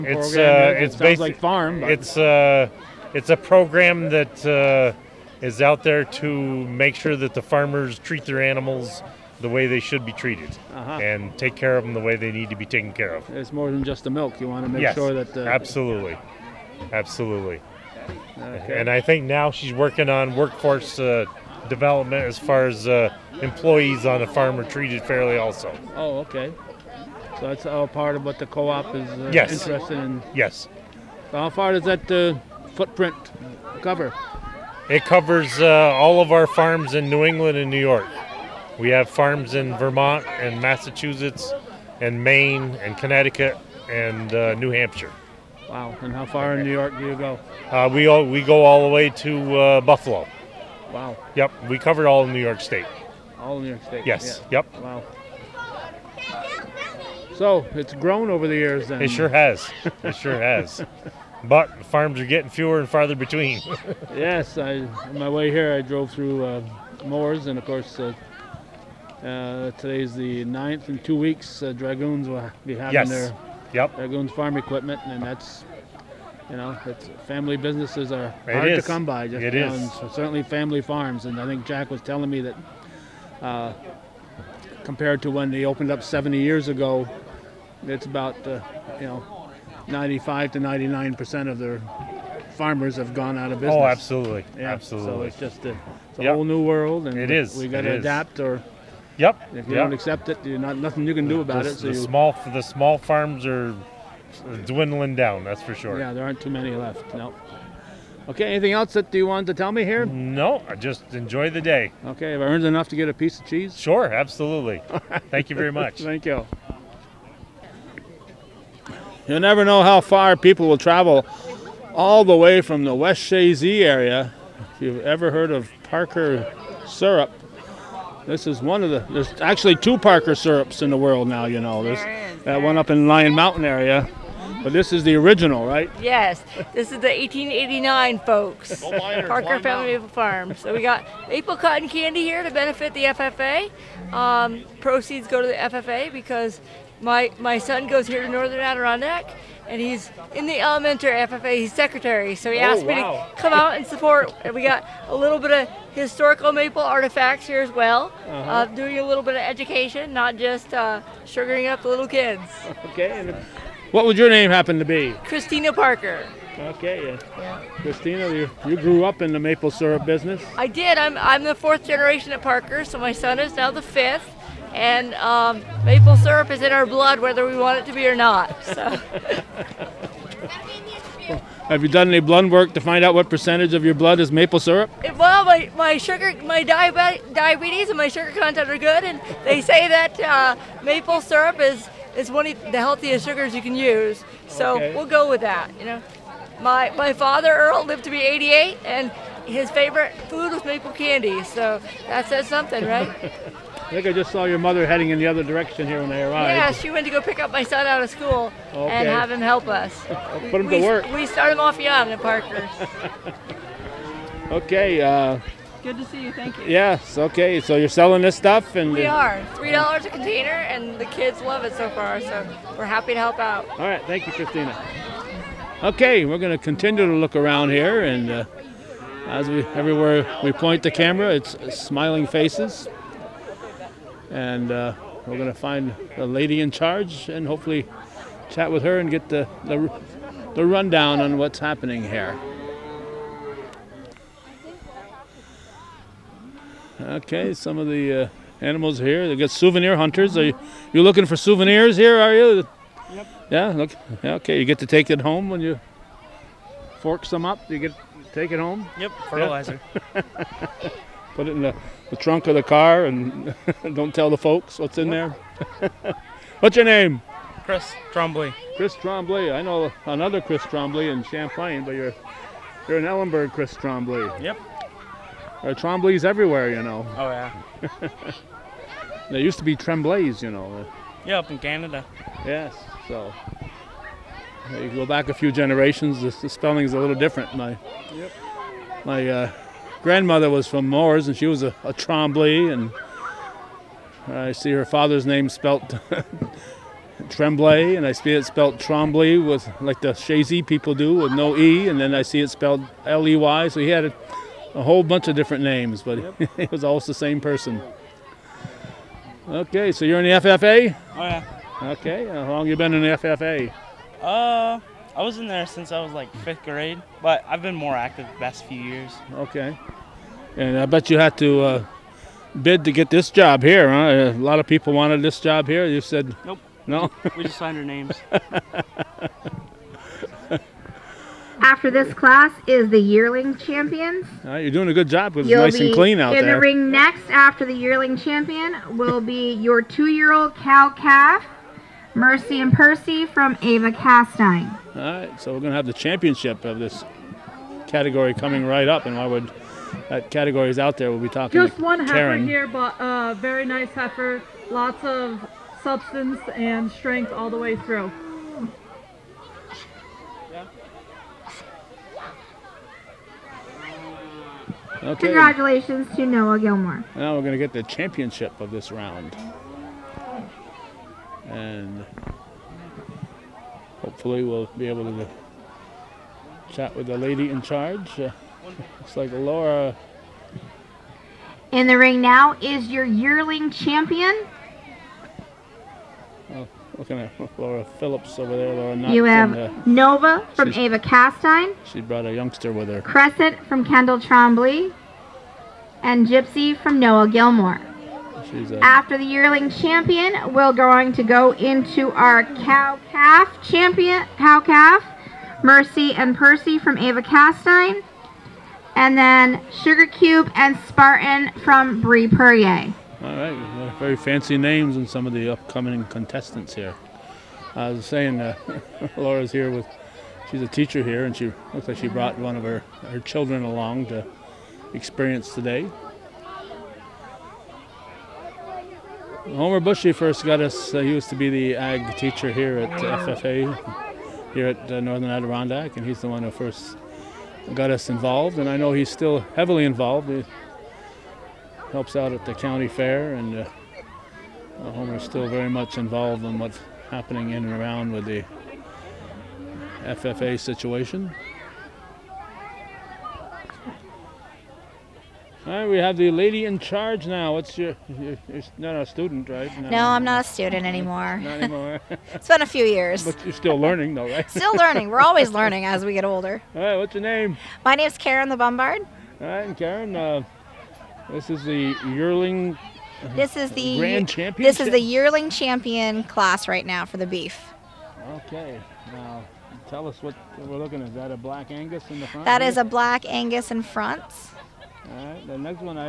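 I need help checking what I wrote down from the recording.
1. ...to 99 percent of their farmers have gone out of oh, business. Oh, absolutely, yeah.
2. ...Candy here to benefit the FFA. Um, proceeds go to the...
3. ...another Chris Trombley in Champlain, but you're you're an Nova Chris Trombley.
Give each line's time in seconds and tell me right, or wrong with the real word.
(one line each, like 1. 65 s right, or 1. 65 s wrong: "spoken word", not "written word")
1. 90 s right
2. 141 s right
3. 270 s wrong: "Ellenburg", not "Nova".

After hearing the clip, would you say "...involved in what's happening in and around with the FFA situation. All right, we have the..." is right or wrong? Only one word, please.
right.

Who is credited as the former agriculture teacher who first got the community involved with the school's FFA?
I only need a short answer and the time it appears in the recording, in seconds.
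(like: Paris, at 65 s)
Homer Bushy, at 429 s.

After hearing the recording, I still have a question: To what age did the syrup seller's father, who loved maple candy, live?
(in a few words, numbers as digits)
88.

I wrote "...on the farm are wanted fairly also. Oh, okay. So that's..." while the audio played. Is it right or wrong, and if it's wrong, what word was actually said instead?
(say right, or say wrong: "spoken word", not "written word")
wrong: "treated", not "wanted".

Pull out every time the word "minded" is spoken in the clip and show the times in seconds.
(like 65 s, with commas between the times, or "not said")
not said.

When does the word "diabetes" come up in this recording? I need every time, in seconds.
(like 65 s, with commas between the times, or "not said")
186 s.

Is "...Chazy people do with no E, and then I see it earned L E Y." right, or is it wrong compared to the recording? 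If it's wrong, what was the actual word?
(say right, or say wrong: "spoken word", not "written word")
wrong: "spelled", not "earned".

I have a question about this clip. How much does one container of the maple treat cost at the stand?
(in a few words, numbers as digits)
3 dollars.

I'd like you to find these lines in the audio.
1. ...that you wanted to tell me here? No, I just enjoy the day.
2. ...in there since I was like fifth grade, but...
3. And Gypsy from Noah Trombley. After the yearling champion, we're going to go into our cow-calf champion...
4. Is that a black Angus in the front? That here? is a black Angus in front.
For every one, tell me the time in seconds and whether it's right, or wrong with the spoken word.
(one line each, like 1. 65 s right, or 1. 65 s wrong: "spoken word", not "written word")
1. 108 s right
2. 315 s right
3. 396 s wrong: "Gilmore", not "Trombley"
4. 481 s right.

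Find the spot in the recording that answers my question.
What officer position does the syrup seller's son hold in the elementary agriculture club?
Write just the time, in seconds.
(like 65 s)
151 s.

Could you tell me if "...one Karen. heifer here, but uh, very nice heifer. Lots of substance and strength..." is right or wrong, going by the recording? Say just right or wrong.
right.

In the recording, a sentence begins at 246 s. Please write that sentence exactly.
Okay, some of the uh, animals here.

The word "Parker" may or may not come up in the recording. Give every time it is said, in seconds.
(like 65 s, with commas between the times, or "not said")
125 s, 129 s, 138 s, 165 s, 172 s, 212 s.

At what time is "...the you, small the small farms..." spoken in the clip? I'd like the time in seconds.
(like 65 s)
101 s.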